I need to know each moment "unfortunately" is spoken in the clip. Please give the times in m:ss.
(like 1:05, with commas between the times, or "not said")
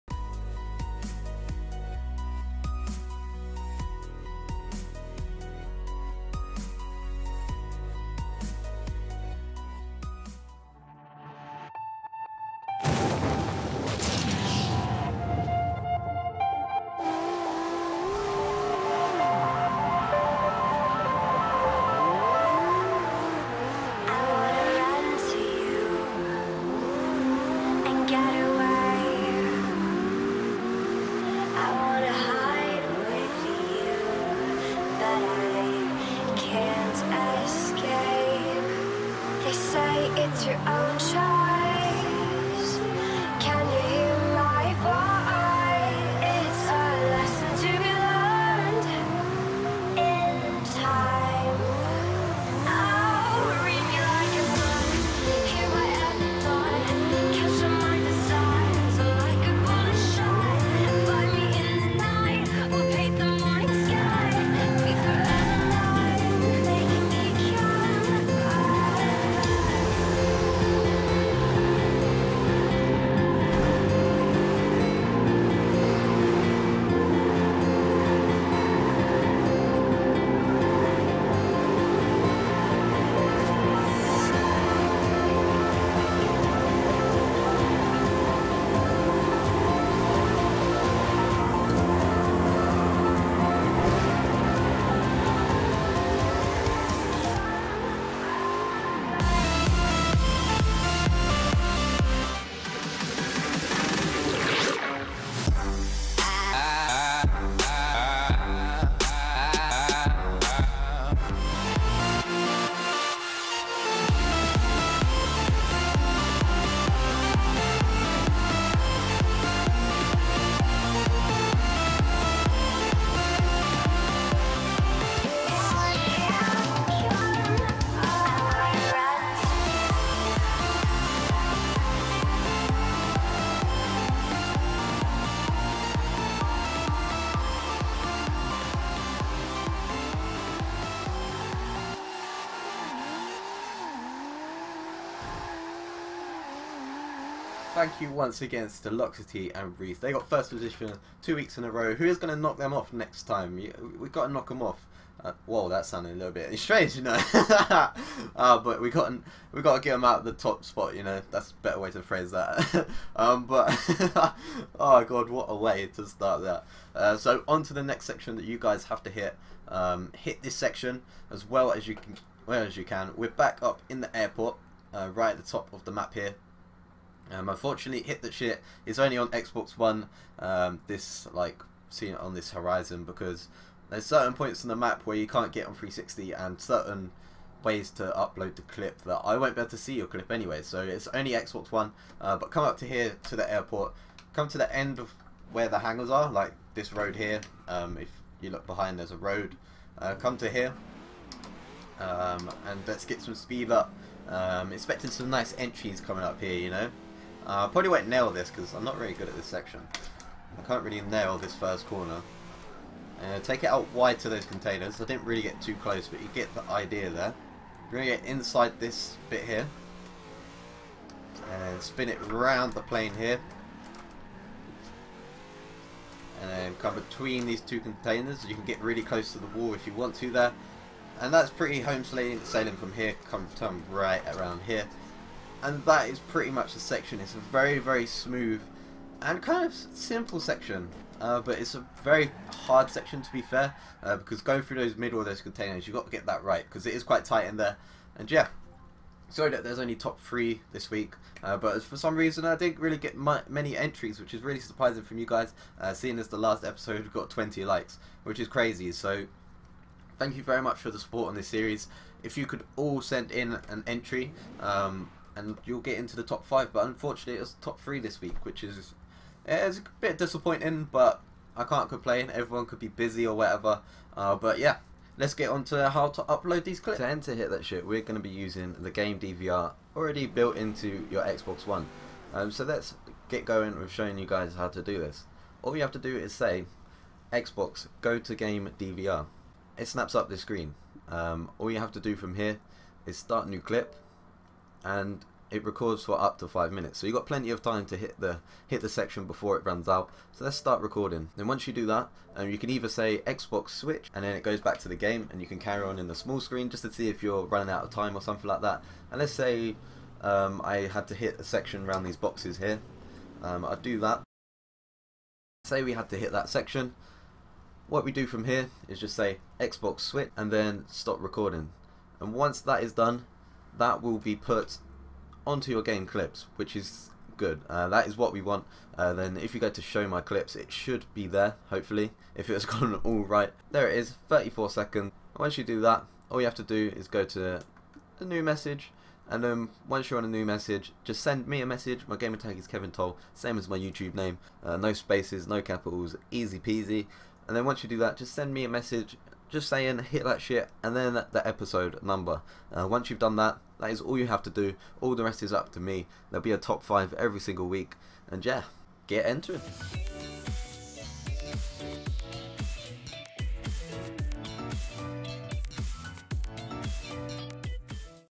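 2:57, 4:26.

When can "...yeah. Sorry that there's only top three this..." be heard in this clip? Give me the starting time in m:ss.
4:08.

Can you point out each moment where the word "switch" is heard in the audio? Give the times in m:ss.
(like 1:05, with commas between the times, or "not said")
5:03, 5:19.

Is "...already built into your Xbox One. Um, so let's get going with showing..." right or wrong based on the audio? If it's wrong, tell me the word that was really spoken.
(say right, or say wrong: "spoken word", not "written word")
right.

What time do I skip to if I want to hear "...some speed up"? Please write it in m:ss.
3:23.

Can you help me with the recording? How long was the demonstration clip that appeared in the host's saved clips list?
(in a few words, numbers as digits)
34 seconds.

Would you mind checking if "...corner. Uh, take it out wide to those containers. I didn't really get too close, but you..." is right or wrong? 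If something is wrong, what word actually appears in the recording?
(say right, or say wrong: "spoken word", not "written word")
right.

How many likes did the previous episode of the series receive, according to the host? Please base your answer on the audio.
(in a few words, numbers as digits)
20.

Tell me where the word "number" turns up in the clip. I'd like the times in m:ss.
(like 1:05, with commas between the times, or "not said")
5:52.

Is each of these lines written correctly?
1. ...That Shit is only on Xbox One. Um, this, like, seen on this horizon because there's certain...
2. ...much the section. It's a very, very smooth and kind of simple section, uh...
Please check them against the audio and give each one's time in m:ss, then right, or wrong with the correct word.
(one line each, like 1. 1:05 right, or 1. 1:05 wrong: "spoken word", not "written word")
1. 2:58 right
2. 3:56 right.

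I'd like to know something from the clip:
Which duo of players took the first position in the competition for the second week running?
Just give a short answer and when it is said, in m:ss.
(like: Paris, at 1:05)
Loxaty and Reese, at 2:28.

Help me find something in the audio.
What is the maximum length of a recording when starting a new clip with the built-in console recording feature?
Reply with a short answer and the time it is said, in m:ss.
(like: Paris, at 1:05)
5 minutes, at 4:56.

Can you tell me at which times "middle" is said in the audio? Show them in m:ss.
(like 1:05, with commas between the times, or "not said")
4:04.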